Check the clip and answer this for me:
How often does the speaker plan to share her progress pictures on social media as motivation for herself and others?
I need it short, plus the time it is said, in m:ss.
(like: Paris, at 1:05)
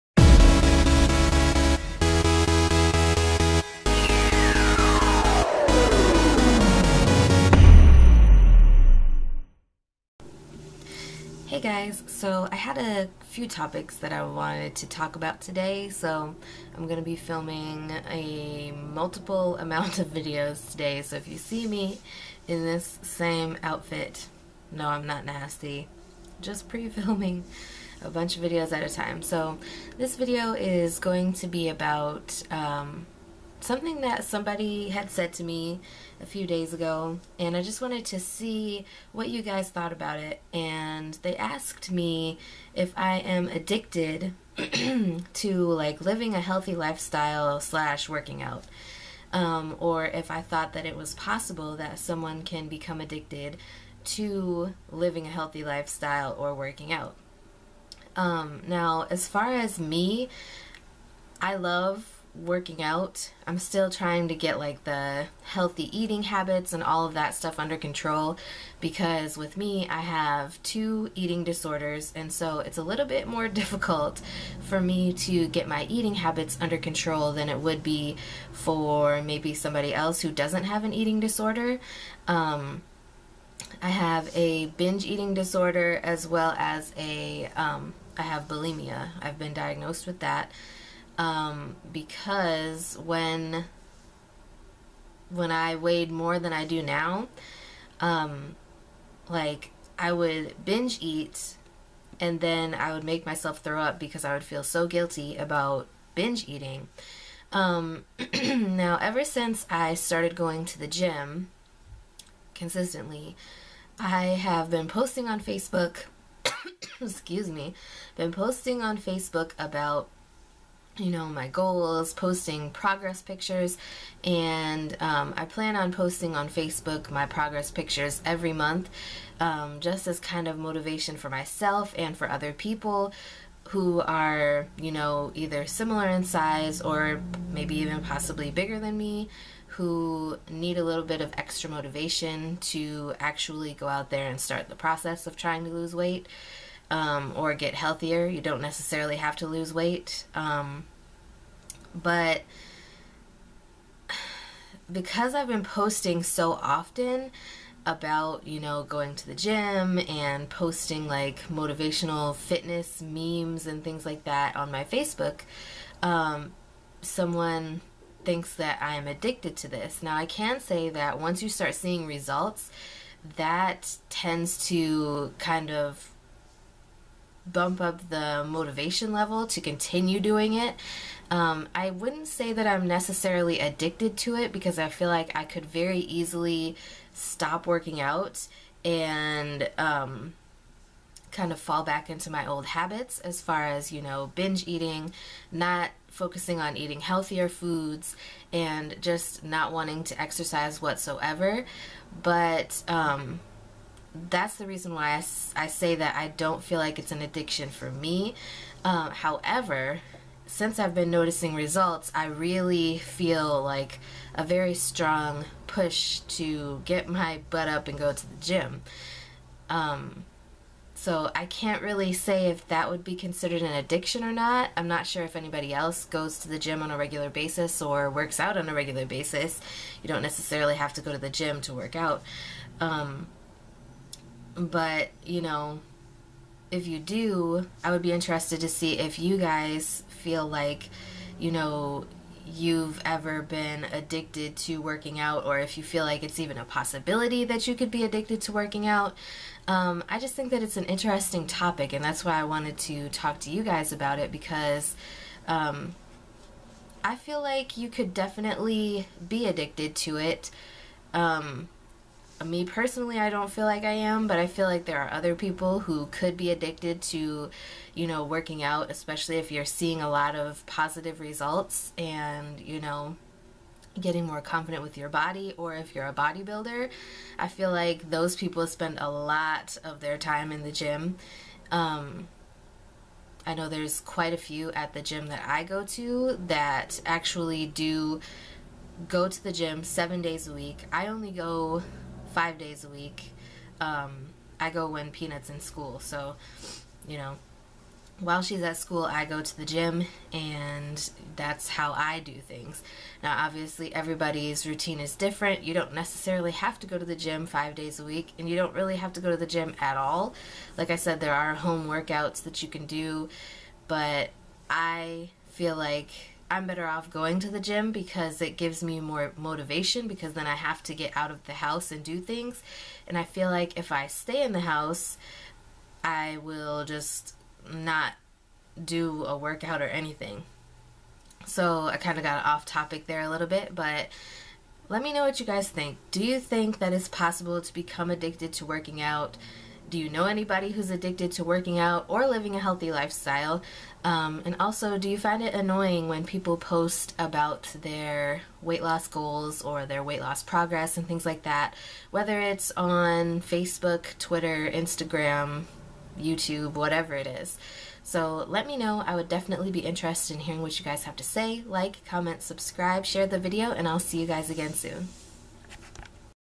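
Every month, at 2:08.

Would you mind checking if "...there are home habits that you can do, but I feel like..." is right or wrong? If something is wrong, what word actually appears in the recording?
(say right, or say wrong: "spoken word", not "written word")
wrong: "workouts", not "habits".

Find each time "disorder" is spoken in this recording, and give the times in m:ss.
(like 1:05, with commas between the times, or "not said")
1:11, 1:21, 1:25.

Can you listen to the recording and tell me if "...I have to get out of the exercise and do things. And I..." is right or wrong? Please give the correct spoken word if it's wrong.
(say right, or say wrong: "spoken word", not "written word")
wrong: "house", not "exercise".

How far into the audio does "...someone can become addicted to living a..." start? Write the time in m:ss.
0:51.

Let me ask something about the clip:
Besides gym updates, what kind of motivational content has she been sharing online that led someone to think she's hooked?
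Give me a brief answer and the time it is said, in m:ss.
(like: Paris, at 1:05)
Fitness memes, at 2:42.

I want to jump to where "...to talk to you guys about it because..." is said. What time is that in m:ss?
4:12.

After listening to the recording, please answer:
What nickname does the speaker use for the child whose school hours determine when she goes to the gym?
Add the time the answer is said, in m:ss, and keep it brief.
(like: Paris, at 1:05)
Peanut, at 4:55.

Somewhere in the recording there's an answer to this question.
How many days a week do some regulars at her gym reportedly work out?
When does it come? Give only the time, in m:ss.
4:49.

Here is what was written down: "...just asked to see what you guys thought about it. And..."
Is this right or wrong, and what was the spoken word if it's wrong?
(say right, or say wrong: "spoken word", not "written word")
wrong: "wanted", not "asked".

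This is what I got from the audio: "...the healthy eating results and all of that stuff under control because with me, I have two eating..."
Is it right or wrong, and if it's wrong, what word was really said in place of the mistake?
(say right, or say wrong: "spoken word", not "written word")
wrong: "habits", not "results".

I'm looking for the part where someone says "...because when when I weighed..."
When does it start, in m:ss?
1:31.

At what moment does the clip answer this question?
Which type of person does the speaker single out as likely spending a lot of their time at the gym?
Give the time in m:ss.
4:36.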